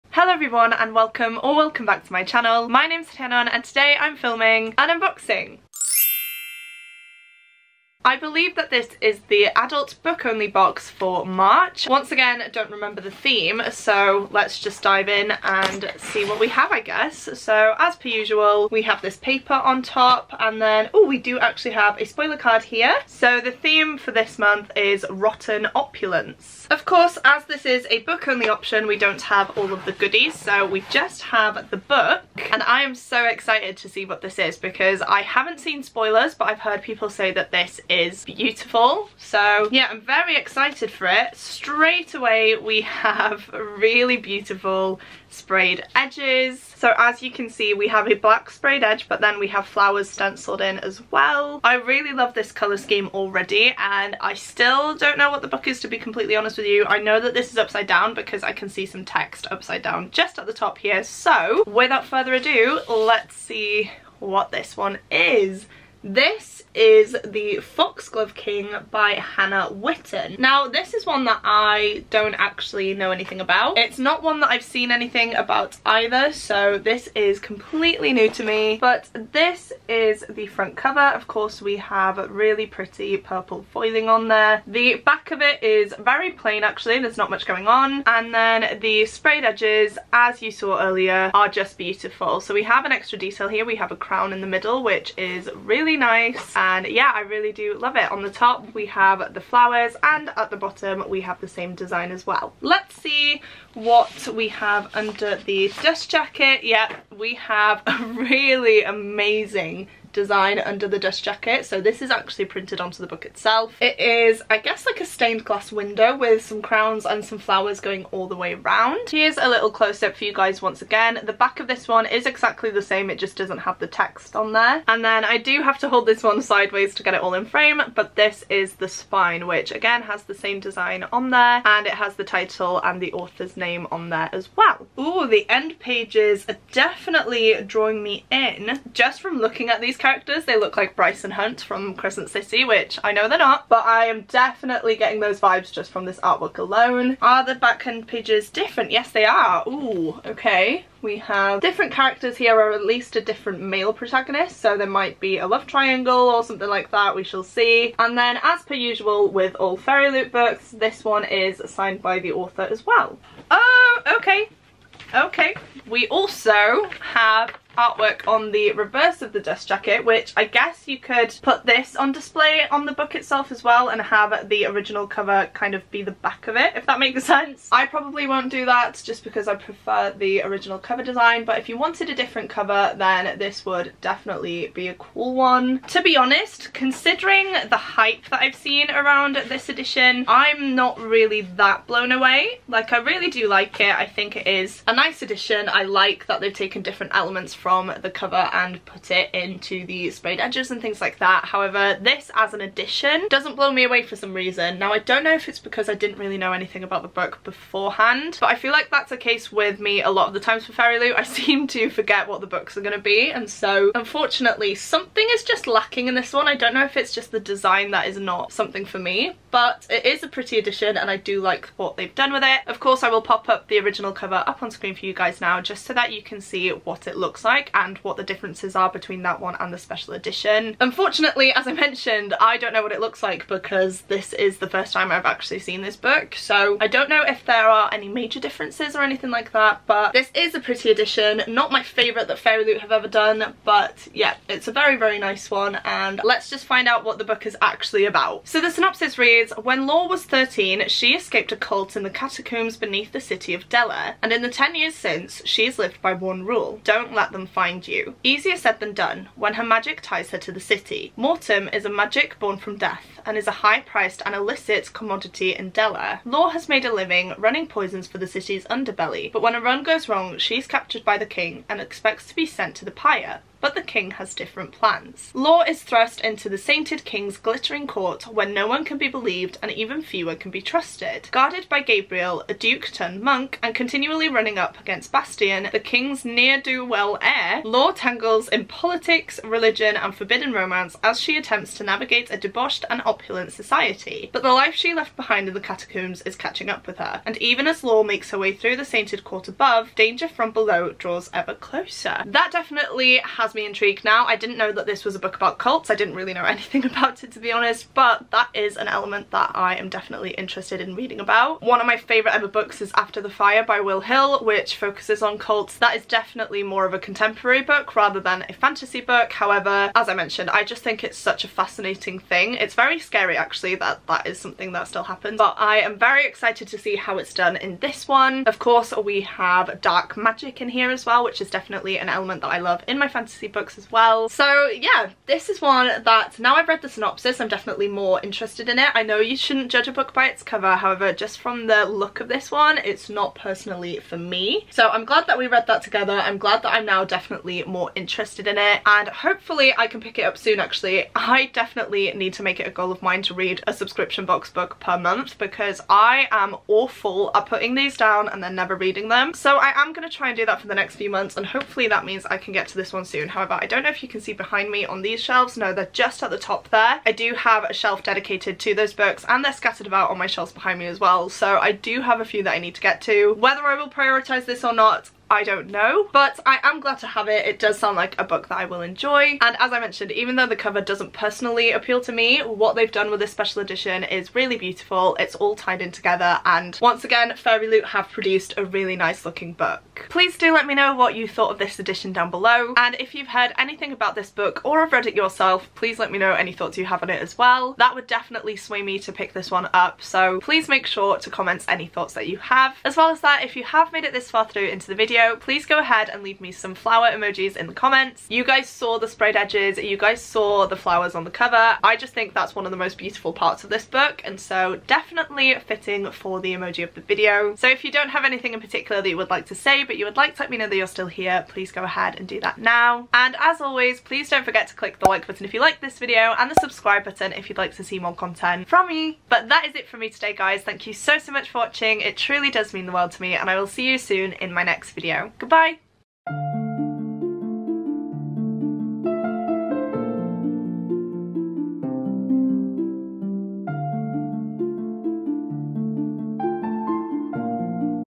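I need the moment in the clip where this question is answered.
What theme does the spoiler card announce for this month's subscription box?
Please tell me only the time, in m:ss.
0:25.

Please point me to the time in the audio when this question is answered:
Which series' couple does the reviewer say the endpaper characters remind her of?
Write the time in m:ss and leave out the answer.
2:21.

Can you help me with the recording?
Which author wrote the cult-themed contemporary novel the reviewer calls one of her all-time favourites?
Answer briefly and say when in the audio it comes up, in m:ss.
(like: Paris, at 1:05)
Will Hill, at 5:13.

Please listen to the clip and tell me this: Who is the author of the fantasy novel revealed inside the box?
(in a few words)
Hannah Whitten.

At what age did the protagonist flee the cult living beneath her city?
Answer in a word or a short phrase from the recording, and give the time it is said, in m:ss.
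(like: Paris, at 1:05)
13, at 4:10.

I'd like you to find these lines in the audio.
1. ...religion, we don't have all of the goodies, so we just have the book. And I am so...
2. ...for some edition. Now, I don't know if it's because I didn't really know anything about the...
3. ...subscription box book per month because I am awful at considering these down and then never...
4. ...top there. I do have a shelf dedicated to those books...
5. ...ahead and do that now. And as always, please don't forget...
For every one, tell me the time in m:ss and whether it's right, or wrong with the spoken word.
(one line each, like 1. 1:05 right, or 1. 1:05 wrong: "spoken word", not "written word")
1. 0:28 wrong: "option", not "religion"
2. 3:24 wrong: "reason", not "edition"
3. 5:53 wrong: "putting", not "considering"
4. 6:06 right
5. 7:01 right.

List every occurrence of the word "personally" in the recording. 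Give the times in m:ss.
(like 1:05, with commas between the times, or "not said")
5:43, 6:21.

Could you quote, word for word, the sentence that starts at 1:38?
On the top we have the flowers and at the bottom we have the same design as well.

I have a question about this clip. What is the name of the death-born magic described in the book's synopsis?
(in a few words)
Mortem.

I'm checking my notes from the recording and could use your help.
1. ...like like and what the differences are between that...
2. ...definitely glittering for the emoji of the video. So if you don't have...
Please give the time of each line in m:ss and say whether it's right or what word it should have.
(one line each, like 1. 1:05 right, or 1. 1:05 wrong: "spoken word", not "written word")
1. 3:47 right
2. 6:54 wrong: "fitting", not "glittering".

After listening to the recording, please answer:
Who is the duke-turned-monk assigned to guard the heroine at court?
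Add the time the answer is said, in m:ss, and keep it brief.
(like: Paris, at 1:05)
Gabriel, at 4:41.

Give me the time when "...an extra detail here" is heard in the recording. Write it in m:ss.
1:32.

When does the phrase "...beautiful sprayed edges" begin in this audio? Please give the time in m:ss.
0:44.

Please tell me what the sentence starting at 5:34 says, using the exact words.
So yeah, this is one that now I've read the synopsis, I'm definitely more interested in it.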